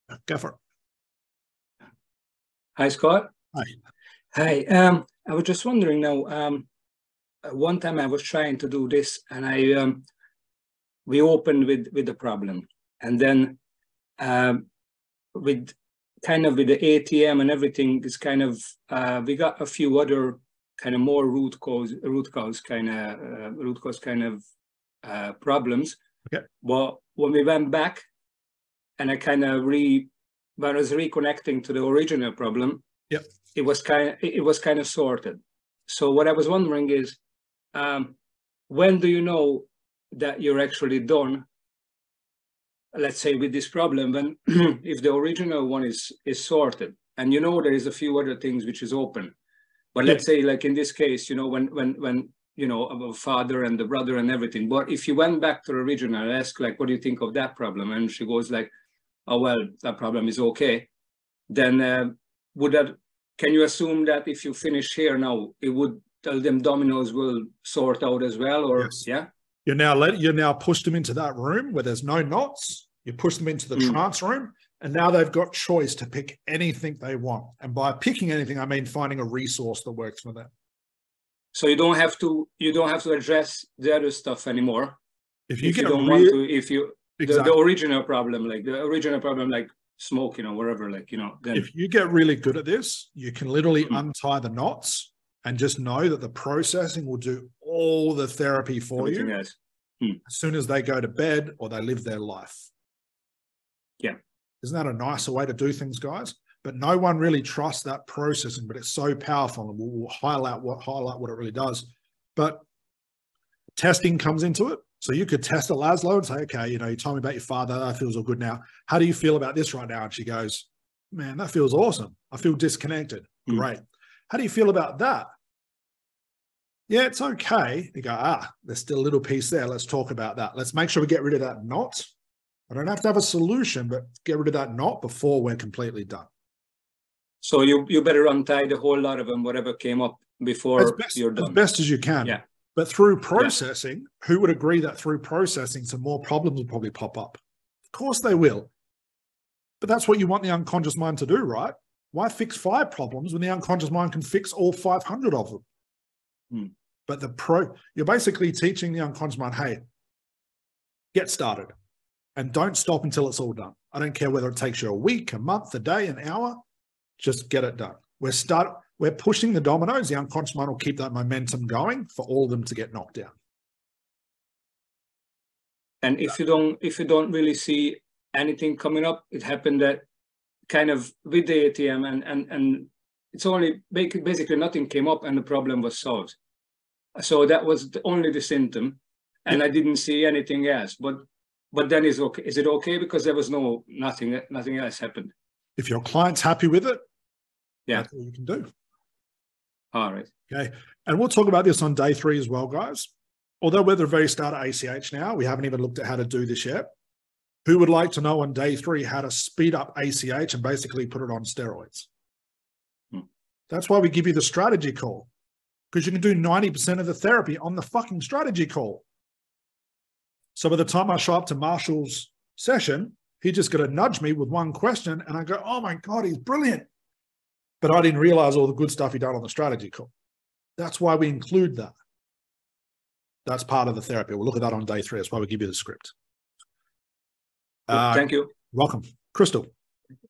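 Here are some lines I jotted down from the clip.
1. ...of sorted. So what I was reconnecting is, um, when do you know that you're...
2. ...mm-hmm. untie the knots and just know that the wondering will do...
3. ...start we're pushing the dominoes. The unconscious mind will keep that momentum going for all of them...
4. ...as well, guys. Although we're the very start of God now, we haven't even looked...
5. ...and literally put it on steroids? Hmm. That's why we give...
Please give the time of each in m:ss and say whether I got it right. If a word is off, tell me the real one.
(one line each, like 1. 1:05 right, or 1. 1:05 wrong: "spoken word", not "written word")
1. 0:34 wrong: "wondering", not "reconnecting"
2. 1:33 wrong: "processing", not "wondering"
3. 2:48 right
4. 3:22 wrong: "ACH", not "God"
5. 3:30 wrong: "basically", not "literally".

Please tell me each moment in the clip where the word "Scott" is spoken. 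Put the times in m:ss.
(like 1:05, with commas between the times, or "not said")
0:02.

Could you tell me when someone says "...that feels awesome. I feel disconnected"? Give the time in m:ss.
2:01.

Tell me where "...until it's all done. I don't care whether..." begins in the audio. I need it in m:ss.
2:43.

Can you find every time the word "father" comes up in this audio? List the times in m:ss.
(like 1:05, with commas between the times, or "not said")
0:53, 1:57.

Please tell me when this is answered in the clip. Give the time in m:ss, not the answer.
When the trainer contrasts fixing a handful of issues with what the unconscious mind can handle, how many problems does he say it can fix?
2:34.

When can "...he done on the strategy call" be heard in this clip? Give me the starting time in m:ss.
3:49.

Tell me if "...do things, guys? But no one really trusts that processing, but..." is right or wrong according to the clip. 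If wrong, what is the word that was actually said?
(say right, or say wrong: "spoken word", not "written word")
right.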